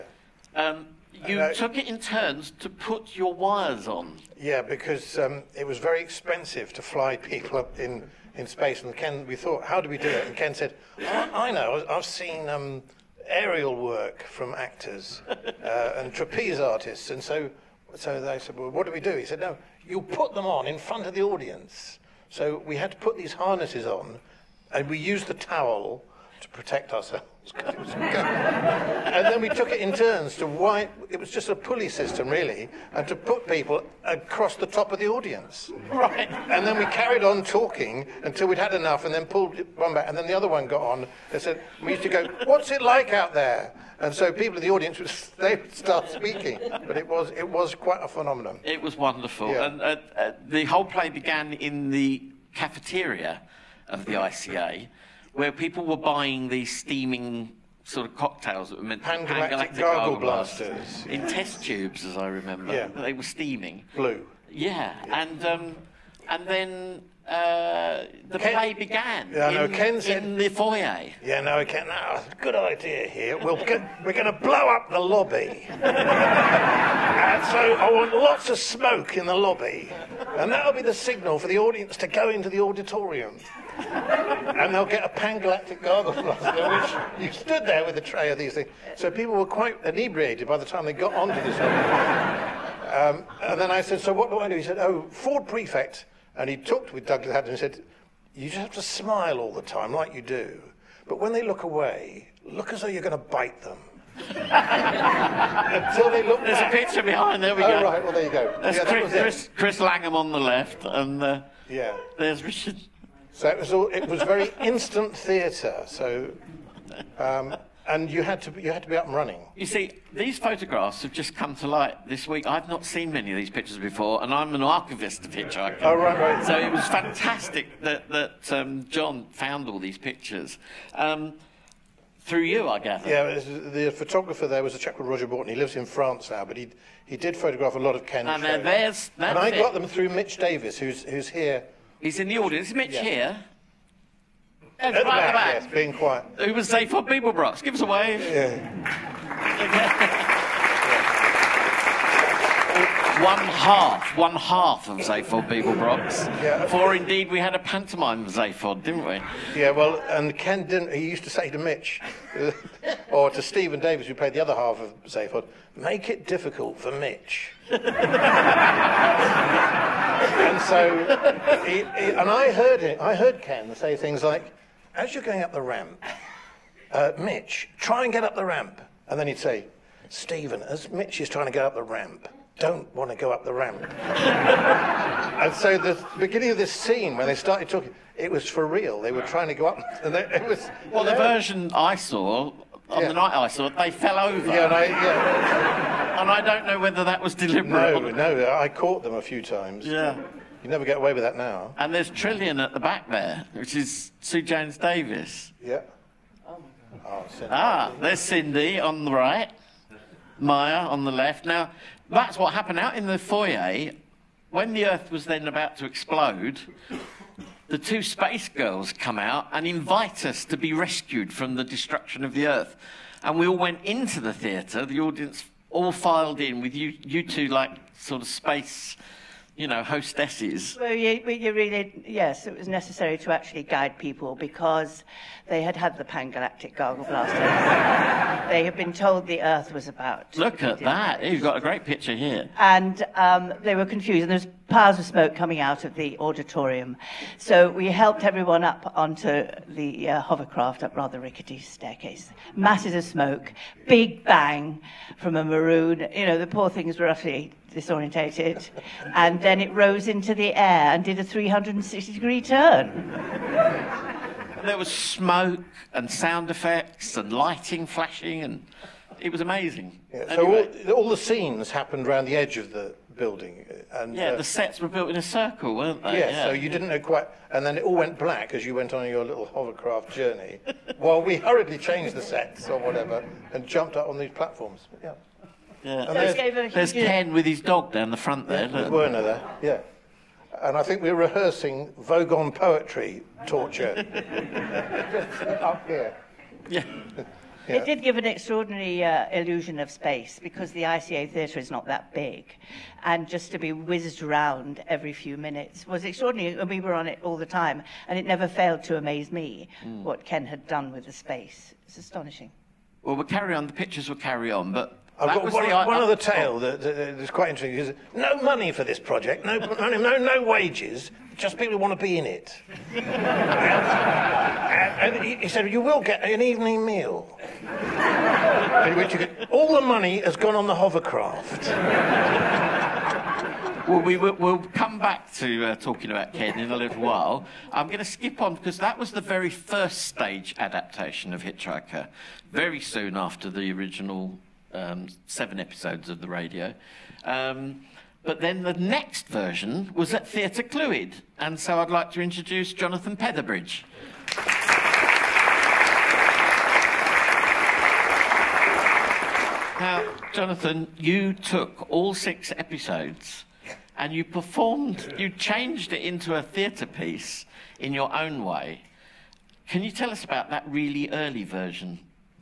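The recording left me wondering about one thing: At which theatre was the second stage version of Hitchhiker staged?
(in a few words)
Theatre Clwyd.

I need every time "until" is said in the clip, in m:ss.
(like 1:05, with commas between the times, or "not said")
0:38, 1:44.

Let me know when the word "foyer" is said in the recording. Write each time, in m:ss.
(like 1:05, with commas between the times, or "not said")
1:10, 3:33.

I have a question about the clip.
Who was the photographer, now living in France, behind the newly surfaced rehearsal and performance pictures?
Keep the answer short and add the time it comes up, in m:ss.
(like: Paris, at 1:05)
Roger Borton, at 2:15.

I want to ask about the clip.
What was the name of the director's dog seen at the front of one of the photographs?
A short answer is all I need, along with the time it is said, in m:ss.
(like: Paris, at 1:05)
Werner, at 4:48.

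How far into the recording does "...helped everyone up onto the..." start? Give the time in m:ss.
4:07.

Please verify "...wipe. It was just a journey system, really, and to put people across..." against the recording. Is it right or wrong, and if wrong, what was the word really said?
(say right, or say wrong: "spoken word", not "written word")
wrong: "pulley", not "journey".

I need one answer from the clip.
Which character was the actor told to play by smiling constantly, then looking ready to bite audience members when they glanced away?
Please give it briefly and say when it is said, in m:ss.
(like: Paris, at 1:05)
Ford Prefect, at 1:35.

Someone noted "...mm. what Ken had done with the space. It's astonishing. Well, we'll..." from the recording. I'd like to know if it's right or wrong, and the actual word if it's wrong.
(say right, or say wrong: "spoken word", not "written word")
right.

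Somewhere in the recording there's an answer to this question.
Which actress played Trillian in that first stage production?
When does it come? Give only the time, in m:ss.
3:24.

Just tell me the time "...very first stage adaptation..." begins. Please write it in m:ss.
5:39.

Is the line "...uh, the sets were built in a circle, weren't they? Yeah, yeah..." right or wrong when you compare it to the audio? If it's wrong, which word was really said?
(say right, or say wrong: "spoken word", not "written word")
right.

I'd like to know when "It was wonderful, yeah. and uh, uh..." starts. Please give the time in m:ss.
0:48.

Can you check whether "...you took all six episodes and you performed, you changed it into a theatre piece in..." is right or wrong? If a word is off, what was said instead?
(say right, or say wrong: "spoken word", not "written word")
right.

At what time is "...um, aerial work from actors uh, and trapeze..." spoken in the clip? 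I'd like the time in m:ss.
0:12.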